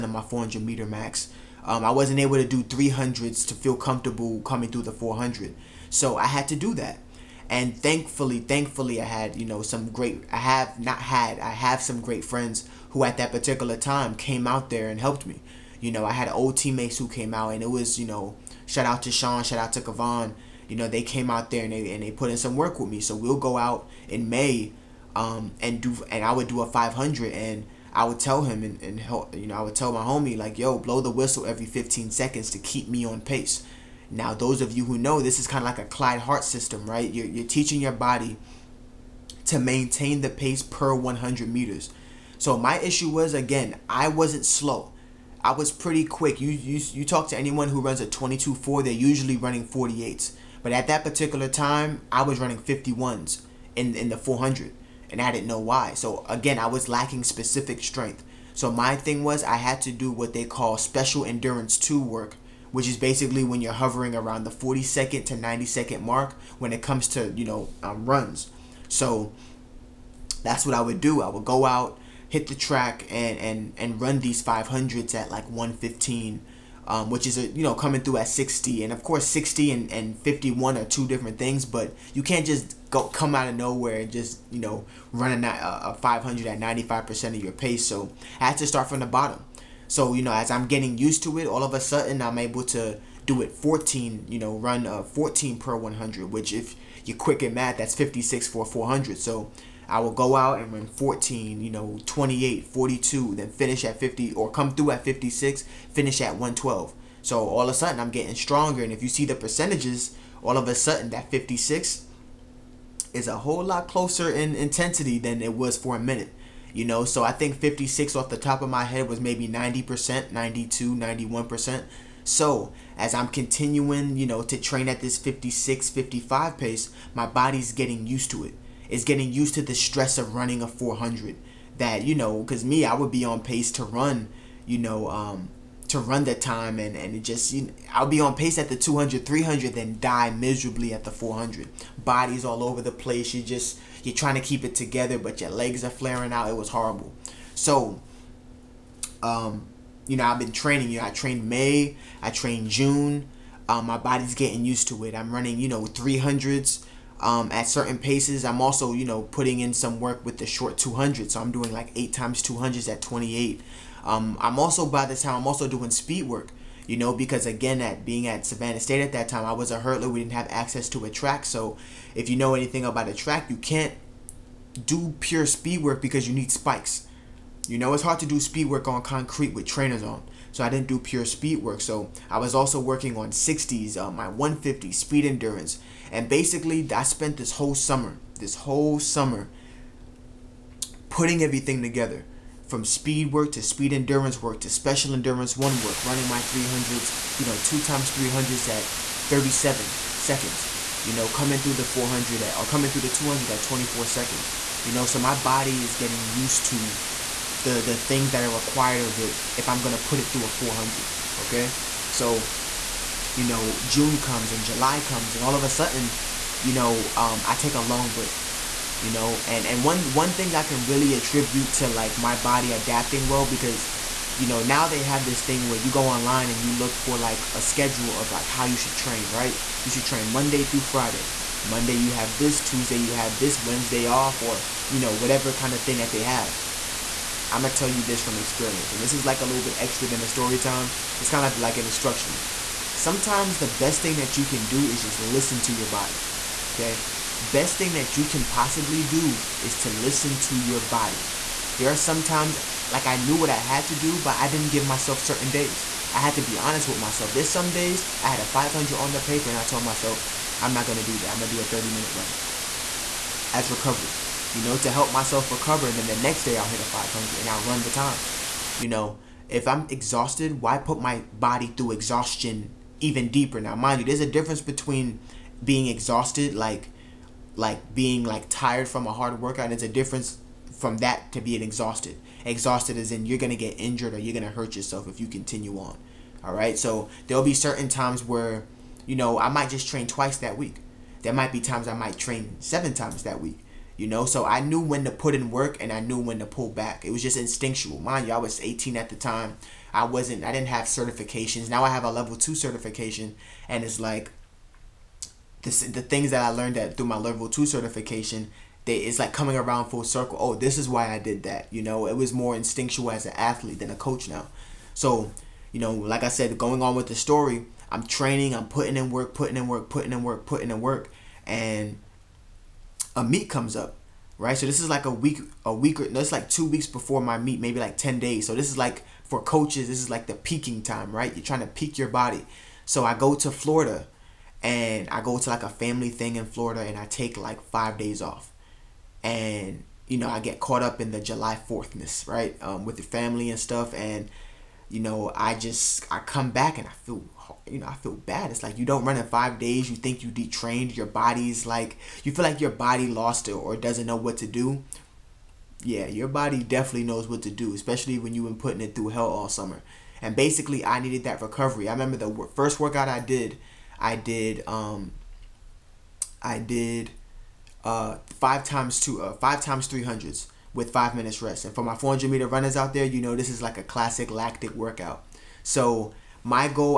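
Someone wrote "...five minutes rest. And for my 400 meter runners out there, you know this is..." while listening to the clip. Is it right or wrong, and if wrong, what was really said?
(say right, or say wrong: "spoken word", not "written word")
right.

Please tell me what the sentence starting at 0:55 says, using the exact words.
So again, I was lacking specific strength.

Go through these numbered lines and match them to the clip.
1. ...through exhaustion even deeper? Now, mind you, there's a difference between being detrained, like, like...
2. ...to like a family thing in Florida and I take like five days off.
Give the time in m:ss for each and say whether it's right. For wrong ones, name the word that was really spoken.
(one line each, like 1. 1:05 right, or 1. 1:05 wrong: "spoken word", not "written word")
1. 4:31 wrong: "exhausted", not "detrained"
2. 5:35 right.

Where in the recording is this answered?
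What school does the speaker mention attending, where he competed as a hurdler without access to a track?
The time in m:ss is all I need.
2:48.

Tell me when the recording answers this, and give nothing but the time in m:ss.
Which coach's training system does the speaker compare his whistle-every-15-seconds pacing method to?
0:35.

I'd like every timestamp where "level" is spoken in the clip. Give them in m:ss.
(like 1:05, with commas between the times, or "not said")
5:02, 5:07.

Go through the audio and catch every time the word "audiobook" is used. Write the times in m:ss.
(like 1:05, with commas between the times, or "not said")
not said.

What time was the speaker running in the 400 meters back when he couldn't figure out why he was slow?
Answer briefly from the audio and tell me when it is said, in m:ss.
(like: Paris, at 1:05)
51, at 0:52.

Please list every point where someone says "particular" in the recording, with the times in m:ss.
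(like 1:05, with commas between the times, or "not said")
0:13, 0:51.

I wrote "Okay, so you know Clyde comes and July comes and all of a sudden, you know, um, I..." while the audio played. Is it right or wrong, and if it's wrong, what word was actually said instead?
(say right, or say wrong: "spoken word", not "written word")
wrong: "June", not "Clyde".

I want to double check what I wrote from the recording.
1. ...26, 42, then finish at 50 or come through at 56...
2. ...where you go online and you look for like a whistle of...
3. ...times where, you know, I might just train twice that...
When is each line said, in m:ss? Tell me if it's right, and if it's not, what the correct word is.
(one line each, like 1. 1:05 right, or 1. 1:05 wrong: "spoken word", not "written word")
1. 1:42 wrong: "28", not "26"
2. 3:45 wrong: "schedule", not "whistle"
3. 4:47 right.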